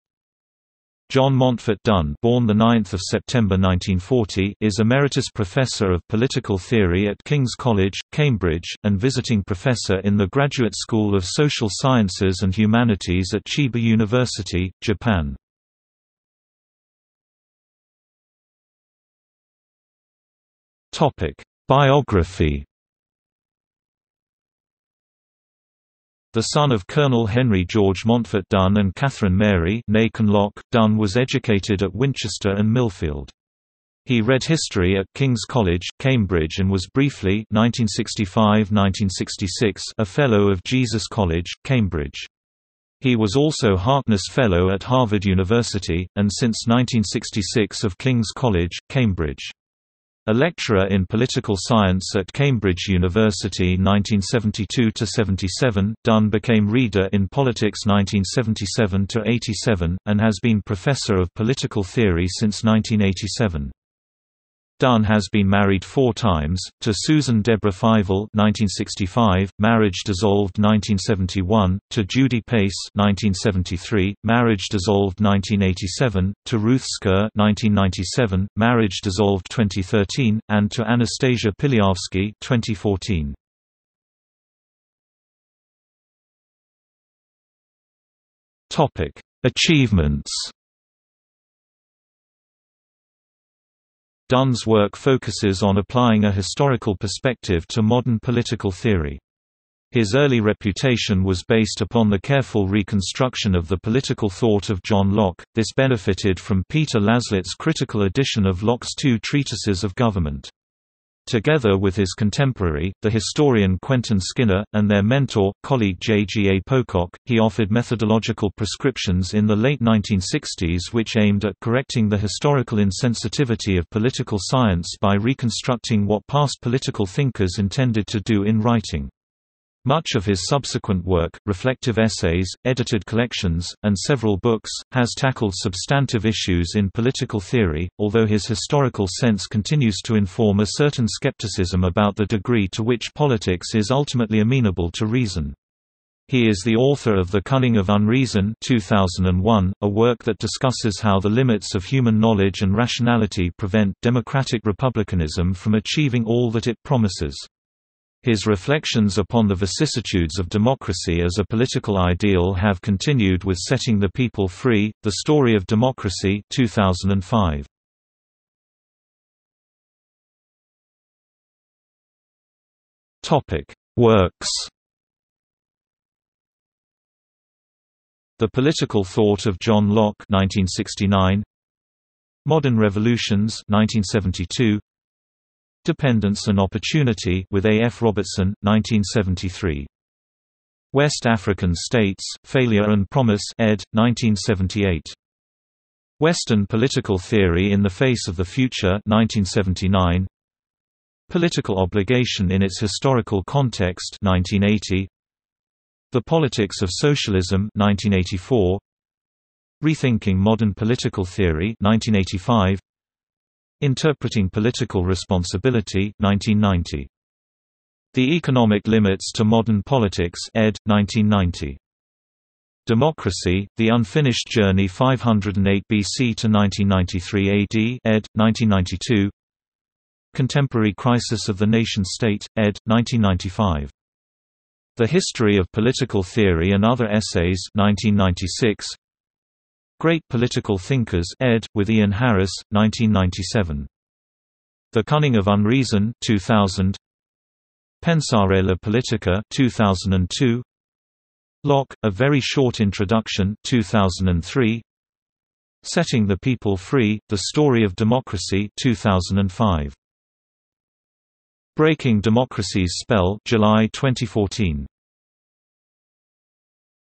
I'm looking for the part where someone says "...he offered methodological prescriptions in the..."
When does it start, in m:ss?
1:57.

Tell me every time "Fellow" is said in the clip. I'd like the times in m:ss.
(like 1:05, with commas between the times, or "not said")
0:40, 0:44.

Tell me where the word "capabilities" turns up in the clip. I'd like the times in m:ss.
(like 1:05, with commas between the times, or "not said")
not said.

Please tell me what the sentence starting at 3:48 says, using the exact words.
1992 Contemporary Crisis of the Nation-State, ed.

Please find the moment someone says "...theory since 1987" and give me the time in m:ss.
1:01.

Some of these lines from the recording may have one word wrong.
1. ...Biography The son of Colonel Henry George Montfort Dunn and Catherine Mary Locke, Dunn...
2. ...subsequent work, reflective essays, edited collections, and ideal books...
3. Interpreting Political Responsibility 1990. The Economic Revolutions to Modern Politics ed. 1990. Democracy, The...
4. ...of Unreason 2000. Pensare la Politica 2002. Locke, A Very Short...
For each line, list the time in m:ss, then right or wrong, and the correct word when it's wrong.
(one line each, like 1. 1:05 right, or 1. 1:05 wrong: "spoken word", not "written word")
1. 0:21 right
2. 2:10 wrong: "several", not "ideal"
3. 3:33 wrong: "Limits", not "Revolutions"
4. 4:05 right.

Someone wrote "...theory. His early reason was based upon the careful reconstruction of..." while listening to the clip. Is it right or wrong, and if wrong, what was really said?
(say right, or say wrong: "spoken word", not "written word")
wrong: "reputation", not "reason".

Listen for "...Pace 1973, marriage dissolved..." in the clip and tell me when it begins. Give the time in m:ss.
1:12.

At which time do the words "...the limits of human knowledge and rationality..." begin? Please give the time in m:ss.
2:31.